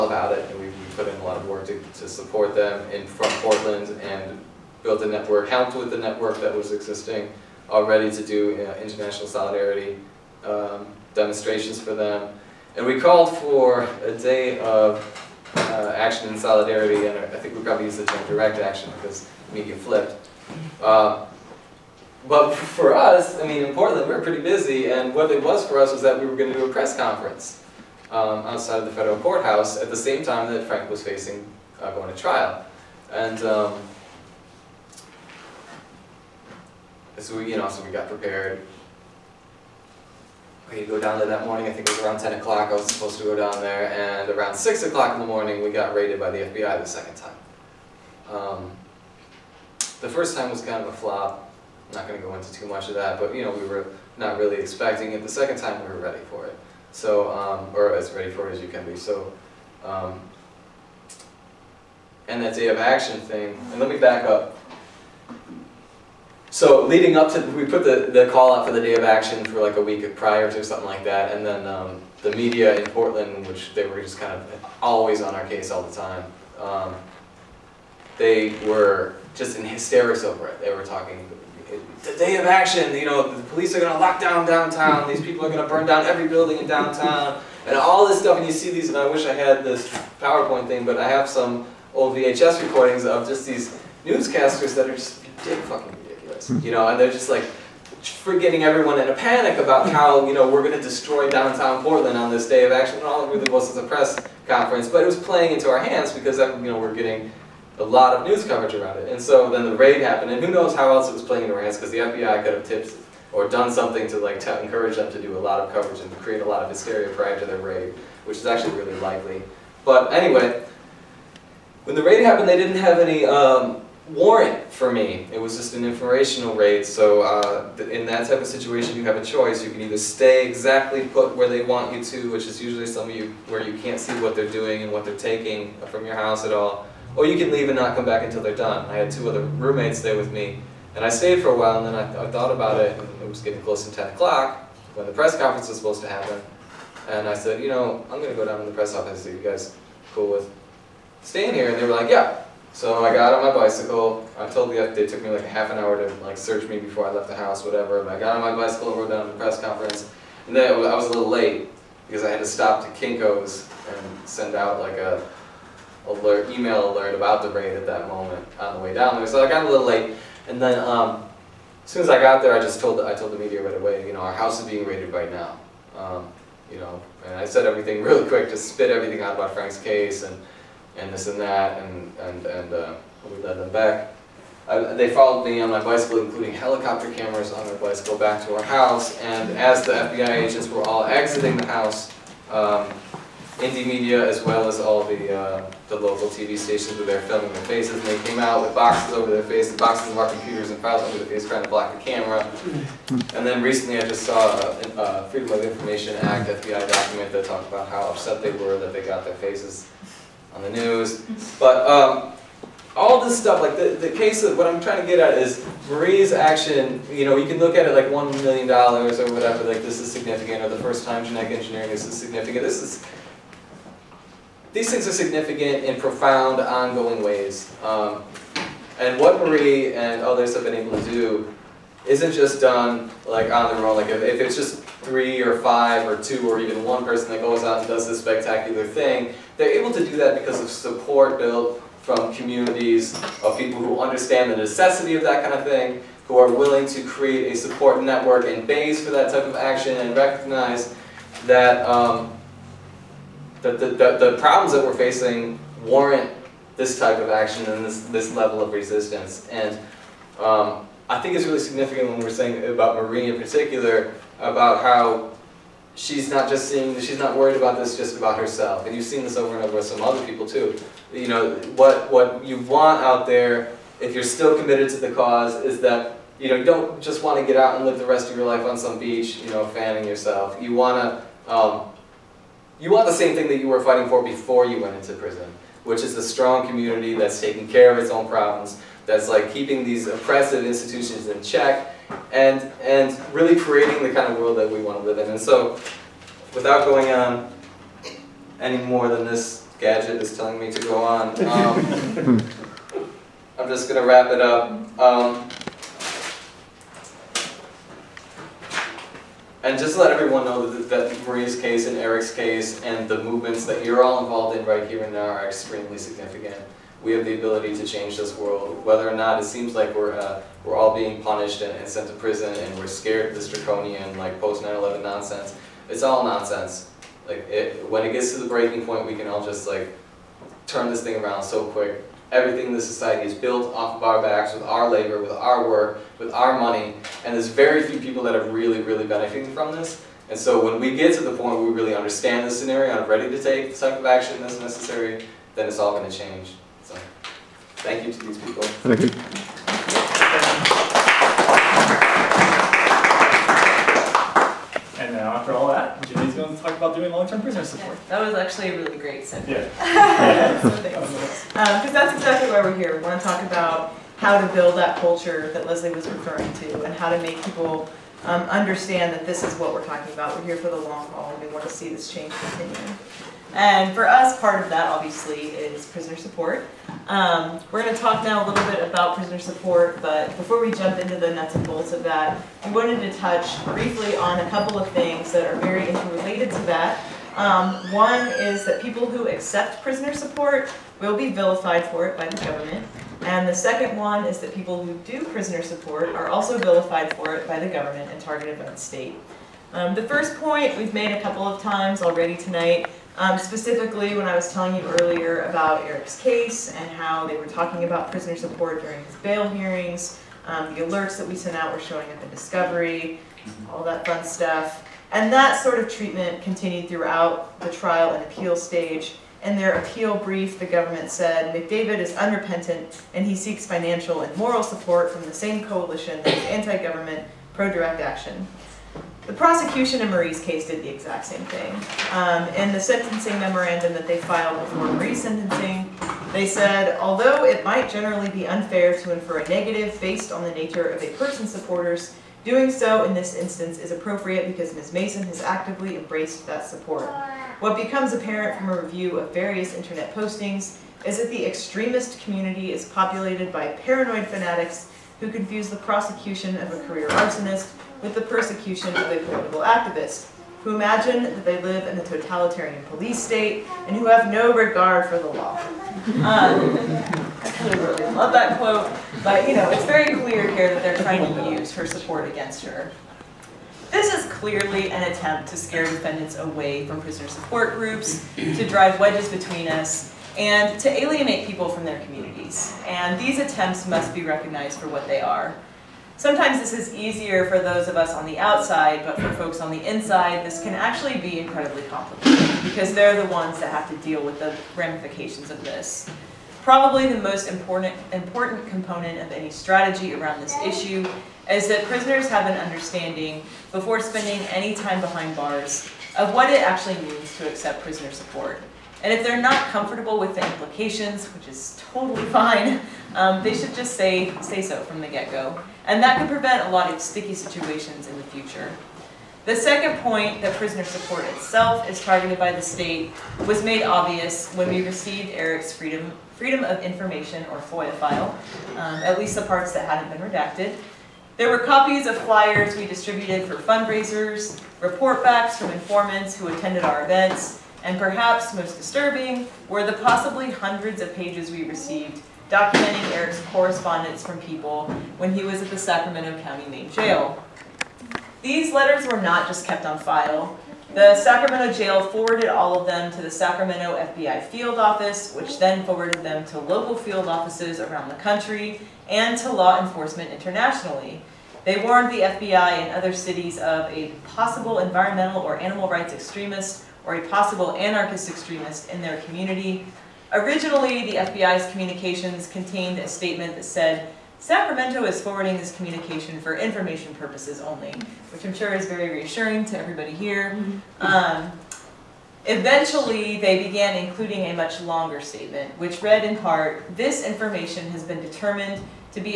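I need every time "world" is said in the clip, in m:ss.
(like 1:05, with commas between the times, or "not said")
4:54, 5:18.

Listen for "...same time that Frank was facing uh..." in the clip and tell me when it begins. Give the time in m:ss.
0:29.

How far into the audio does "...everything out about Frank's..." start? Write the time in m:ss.
2:58.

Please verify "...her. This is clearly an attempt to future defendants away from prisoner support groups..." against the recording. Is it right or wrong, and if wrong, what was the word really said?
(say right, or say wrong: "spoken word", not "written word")
wrong: "scare", not "future".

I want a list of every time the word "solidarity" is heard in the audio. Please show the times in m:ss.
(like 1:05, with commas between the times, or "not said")
0:09, 0:16.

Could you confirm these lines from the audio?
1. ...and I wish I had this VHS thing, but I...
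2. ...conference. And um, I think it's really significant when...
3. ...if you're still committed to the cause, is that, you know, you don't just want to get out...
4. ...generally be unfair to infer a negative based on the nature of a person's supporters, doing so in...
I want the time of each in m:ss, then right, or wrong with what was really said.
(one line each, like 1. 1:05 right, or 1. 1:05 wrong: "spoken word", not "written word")
1. 1:28 wrong: "PowerPoint", not "VHS"
2. 4:18 wrong: "resistance", not "conference"
3. 4:33 right
4. 7:17 right.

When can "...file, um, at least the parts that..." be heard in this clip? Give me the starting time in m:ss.
8:47.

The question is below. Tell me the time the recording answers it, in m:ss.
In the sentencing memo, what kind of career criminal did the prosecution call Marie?
7:36.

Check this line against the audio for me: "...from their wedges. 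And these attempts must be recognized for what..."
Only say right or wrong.
wrong.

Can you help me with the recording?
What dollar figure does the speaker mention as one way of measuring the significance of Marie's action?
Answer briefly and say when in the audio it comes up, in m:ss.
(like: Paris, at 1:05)
1,000,000 dollars, at 3:38.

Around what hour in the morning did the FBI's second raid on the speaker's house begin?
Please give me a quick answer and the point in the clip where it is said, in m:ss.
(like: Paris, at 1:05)
6 o'clock, at 0:44.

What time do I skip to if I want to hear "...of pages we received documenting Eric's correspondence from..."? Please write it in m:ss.
9:01.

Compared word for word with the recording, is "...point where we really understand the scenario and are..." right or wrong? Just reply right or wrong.
right.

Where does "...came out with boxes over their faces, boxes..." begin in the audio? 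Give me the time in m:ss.
3:18.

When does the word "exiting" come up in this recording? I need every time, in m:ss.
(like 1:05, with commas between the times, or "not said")
3:11.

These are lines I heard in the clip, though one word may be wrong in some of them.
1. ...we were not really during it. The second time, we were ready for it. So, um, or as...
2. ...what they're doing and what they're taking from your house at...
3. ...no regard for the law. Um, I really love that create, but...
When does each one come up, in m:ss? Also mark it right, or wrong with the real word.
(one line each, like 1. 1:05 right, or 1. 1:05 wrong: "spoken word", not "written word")
1. 0:53 wrong: "expecting", not "during"
2. 2:14 right
3. 7:44 wrong: "quote", not "create".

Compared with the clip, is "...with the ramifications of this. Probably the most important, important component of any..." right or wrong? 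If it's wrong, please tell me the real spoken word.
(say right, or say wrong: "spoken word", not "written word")
right.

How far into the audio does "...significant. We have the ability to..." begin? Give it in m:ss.
5:15.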